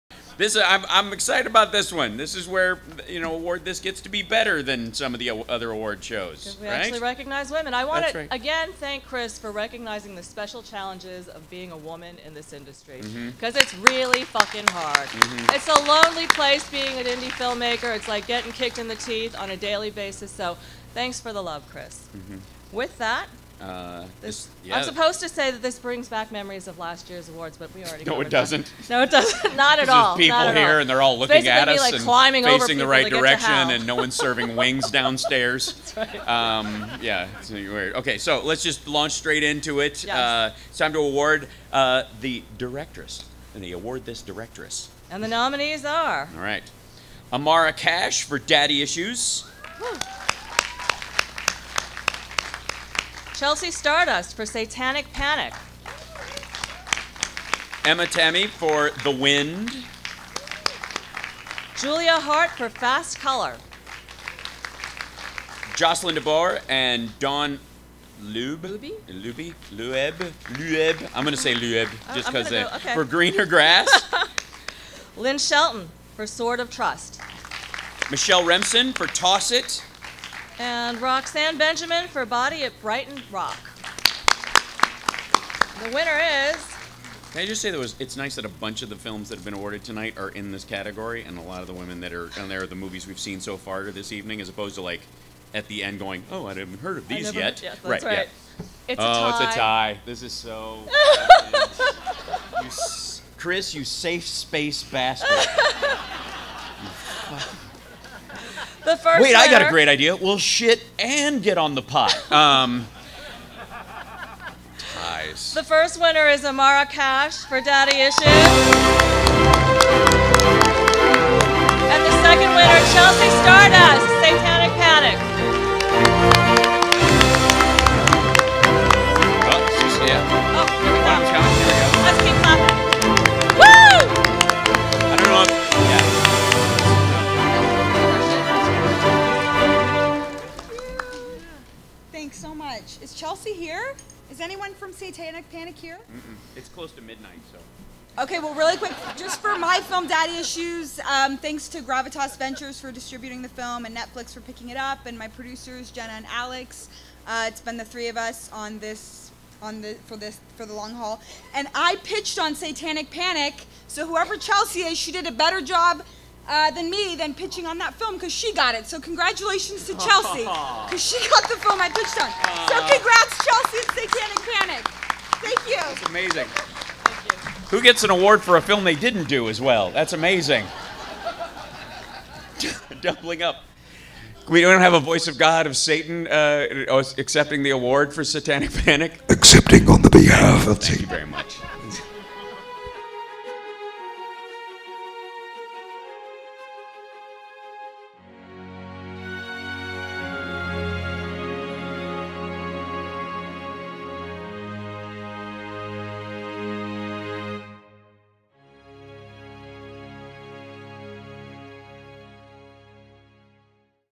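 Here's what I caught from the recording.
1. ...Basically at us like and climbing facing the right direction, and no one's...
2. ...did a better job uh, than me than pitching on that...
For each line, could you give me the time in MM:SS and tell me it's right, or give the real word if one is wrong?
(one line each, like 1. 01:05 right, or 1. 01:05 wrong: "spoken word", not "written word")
1. 00:31 right
2. 02:45 right.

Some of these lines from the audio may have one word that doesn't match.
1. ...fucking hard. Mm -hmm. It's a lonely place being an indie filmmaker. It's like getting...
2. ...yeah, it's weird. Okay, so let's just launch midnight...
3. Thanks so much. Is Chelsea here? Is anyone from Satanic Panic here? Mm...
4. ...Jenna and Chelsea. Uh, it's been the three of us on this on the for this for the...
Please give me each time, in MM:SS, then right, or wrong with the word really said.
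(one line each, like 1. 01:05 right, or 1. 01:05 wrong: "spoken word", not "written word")
1. 00:14 right
2. 00:37 wrong: "straight", not "midnight"
3. 02:22 right
4. 02:35 wrong: "Alex", not "Chelsea".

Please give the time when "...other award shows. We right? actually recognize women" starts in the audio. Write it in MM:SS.
00:05.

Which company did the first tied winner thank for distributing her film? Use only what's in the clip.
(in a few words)
Gravitas Ventures.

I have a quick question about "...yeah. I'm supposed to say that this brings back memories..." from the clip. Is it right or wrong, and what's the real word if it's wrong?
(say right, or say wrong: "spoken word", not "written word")
right.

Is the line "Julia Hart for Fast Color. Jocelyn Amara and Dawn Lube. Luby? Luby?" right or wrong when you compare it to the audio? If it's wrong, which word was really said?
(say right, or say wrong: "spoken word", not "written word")
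wrong: "DeBoer", not "Amara".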